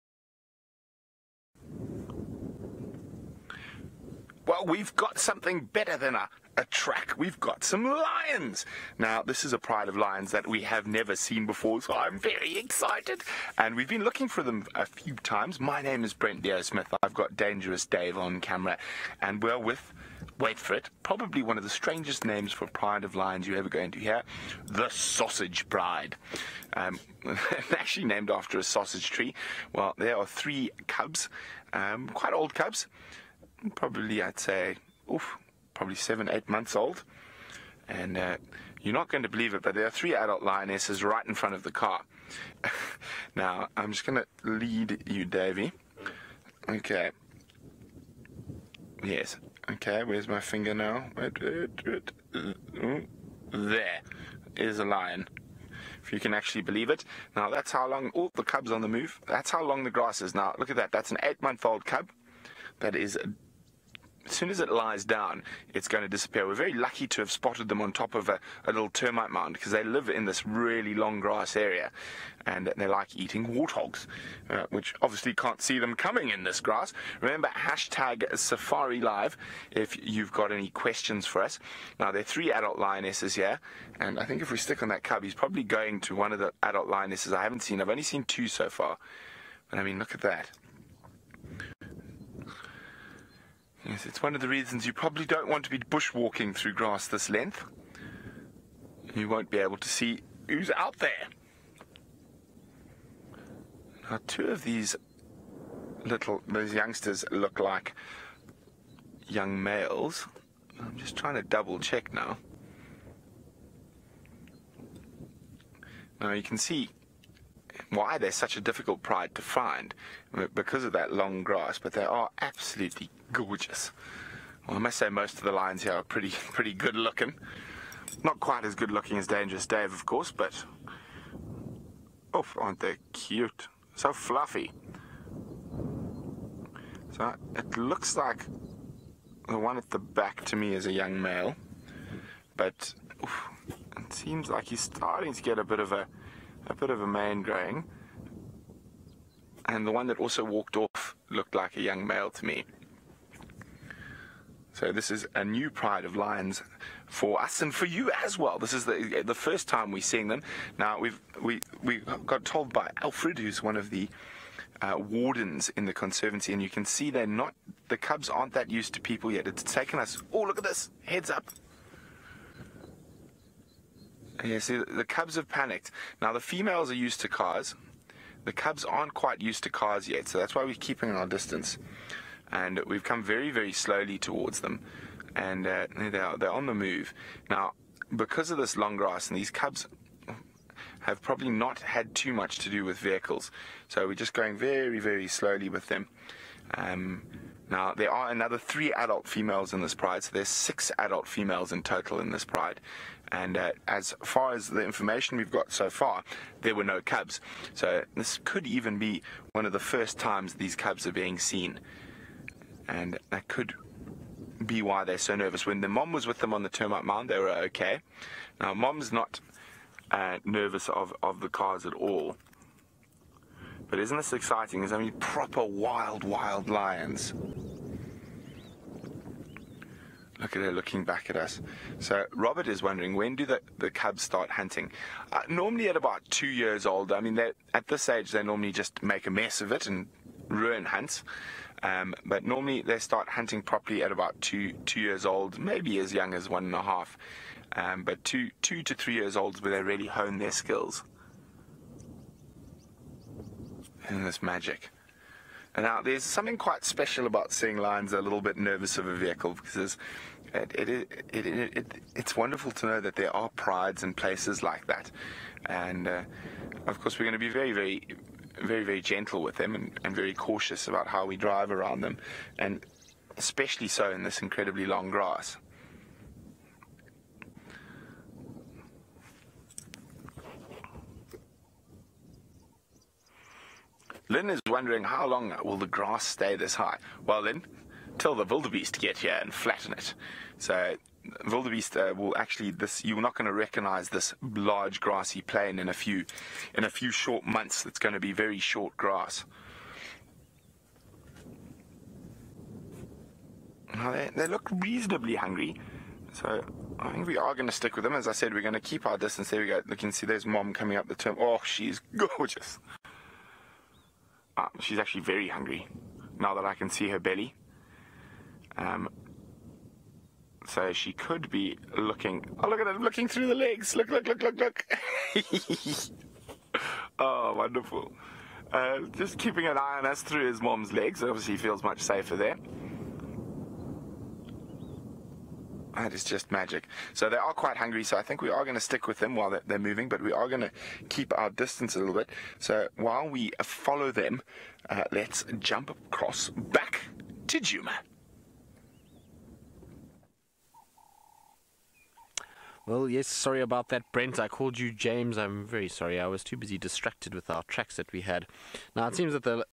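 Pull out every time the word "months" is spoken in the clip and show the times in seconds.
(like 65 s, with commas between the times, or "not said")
36 s, 61 s, 297 s.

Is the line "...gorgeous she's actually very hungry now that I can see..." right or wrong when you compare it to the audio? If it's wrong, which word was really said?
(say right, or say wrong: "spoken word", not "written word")
right.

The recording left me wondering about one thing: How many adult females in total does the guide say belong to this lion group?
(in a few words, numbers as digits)
6.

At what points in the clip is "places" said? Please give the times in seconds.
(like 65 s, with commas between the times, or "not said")
264 s.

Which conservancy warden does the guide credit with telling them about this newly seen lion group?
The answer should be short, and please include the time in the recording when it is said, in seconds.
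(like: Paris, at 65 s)
Alfred, at 163 s.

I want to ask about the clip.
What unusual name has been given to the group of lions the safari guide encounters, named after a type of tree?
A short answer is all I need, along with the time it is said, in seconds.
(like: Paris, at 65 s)
Sausage Pride, at 24 s.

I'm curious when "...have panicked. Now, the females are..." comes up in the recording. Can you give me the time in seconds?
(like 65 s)
175 s.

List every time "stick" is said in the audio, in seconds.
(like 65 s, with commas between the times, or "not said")
84 s, 307 s, 338 s.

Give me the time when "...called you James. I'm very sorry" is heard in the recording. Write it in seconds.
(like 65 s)
354 s.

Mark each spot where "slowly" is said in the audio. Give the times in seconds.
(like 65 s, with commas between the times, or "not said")
183 s, 195 s.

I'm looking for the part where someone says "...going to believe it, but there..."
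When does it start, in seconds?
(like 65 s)
39 s.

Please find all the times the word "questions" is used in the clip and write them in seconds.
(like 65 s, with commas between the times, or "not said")
80 s.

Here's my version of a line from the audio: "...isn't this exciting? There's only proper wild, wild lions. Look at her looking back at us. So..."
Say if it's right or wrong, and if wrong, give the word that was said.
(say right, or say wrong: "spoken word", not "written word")
right.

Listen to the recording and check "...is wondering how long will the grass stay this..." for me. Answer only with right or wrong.
right.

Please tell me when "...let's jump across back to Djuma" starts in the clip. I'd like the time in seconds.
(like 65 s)
345 s.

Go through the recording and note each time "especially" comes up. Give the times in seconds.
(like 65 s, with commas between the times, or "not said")
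273 s.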